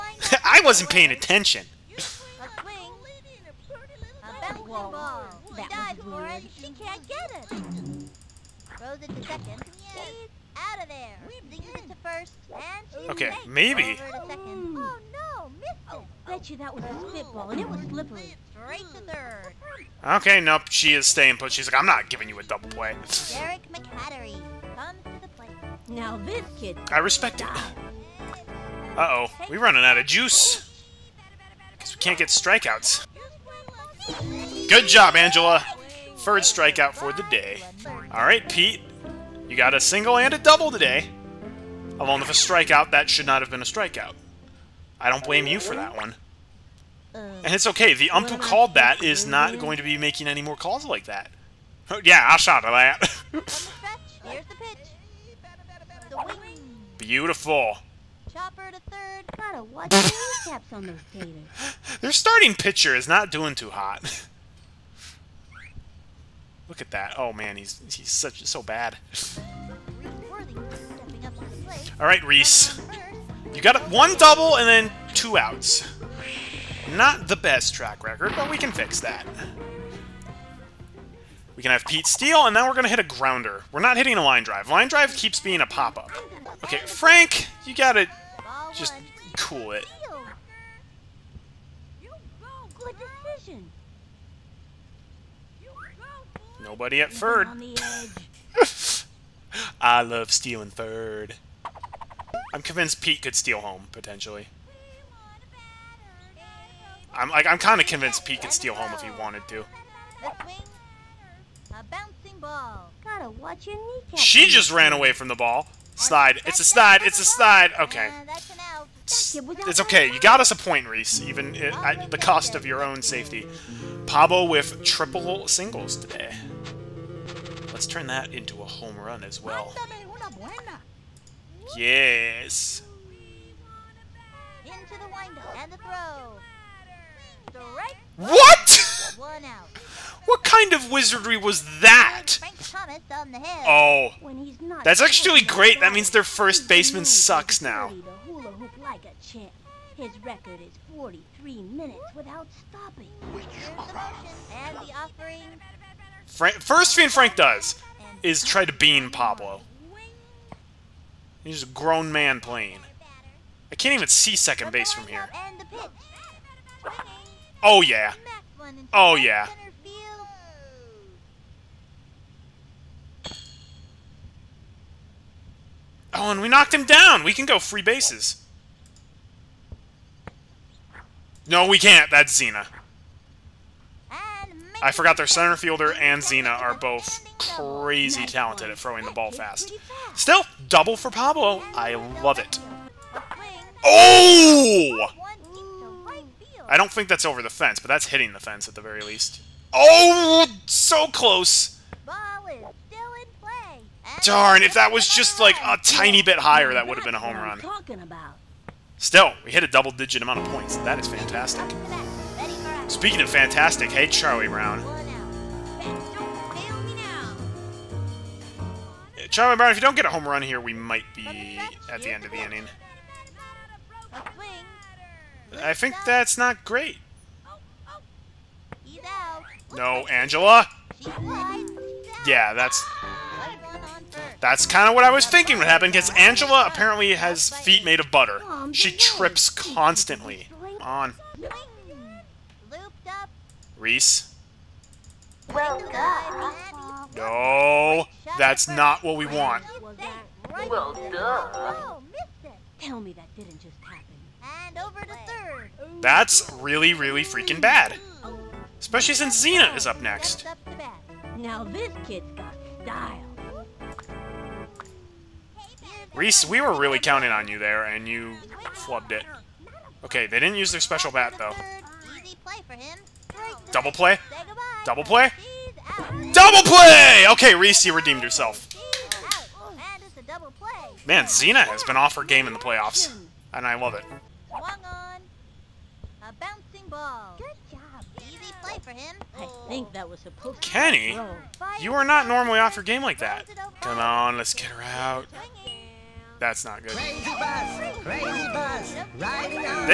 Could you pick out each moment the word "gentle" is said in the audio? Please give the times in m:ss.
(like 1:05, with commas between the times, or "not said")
not said.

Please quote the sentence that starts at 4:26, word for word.
Reese, we were really counting on you there, and you flubbed it.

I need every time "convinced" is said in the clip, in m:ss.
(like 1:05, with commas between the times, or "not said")
1:42, 1:47.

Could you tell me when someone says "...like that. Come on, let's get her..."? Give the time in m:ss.
4:53.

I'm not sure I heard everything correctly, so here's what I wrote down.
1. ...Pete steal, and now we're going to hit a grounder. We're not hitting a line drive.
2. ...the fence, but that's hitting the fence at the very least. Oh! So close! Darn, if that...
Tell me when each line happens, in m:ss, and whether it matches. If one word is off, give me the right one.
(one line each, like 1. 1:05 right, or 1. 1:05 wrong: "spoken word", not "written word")
1. 1:21 right
2. 3:17 right.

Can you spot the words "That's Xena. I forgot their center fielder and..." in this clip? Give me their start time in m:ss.
3:02.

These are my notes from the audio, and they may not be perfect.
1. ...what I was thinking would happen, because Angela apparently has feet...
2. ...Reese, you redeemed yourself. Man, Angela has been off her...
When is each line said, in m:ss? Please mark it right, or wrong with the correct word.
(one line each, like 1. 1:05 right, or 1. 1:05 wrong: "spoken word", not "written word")
1. 3:54 right
2. 4:37 wrong: "Xena", not "Angela".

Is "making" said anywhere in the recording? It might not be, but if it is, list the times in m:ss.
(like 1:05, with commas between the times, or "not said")
0:49.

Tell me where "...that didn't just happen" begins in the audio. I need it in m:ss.
4:13.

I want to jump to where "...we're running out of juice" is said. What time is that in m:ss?
0:29.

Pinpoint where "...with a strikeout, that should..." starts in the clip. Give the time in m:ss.
0:42.